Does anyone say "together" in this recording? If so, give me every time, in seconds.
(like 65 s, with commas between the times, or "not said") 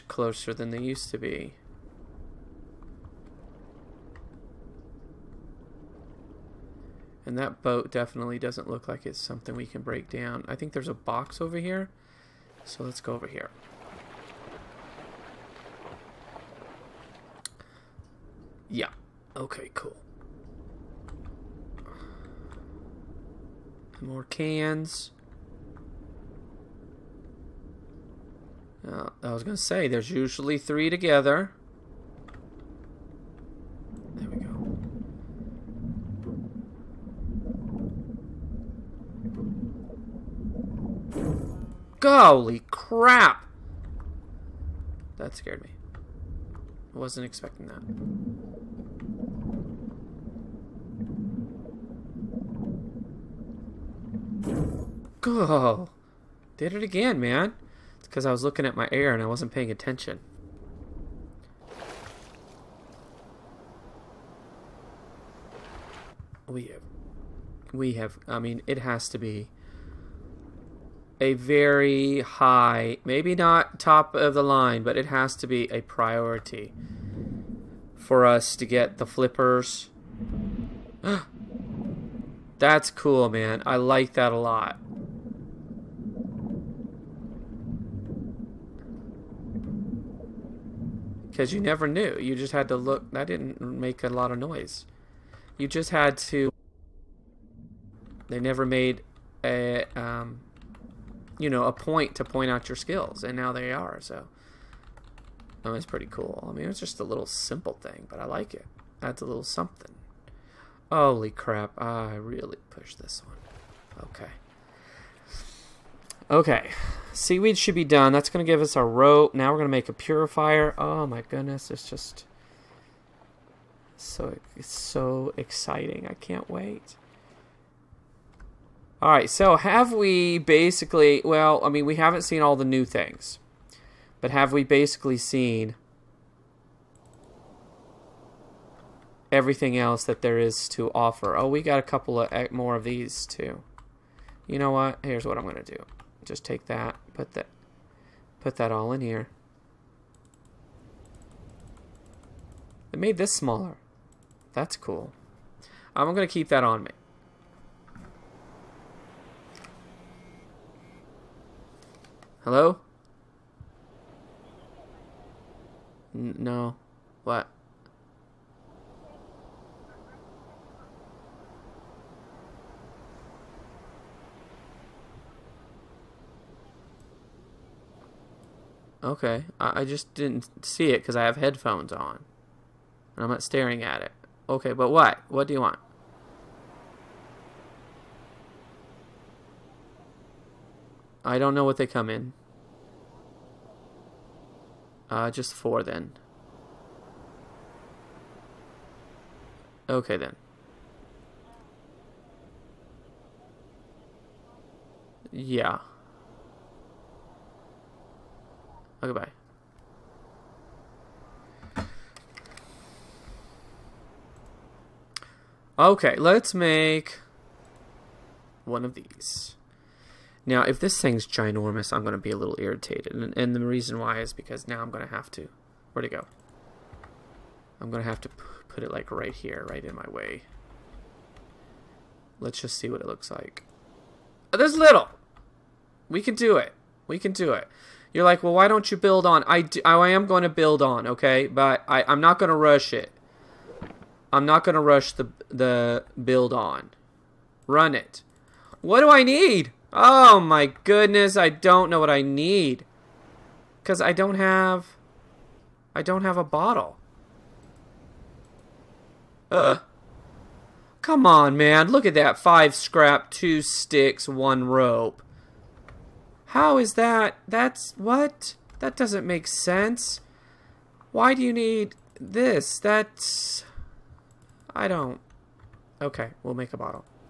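30 s.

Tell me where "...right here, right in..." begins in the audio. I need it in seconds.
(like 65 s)
229 s.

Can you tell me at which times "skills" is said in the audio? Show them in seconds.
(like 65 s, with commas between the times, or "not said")
102 s.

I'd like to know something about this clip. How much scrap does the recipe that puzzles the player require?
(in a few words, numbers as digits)
5.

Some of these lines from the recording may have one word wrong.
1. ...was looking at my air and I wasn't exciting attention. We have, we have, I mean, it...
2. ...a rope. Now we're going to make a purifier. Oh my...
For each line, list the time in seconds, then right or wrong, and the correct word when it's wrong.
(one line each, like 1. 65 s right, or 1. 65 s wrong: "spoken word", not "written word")
1. 58 s wrong: "paying", not "exciting"
2. 118 s right.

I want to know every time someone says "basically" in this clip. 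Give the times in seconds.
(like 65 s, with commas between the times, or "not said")
130 s, 134 s.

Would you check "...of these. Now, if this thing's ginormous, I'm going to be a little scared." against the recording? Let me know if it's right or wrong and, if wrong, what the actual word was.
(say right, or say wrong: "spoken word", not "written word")
wrong: "irritated", not "scared".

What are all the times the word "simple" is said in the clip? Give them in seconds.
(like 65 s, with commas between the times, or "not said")
107 s.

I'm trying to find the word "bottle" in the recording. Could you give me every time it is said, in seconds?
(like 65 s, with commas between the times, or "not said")
256 s, 276 s.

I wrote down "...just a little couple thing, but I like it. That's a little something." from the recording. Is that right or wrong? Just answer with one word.
wrong.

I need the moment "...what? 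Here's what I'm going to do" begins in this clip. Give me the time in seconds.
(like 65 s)
144 s.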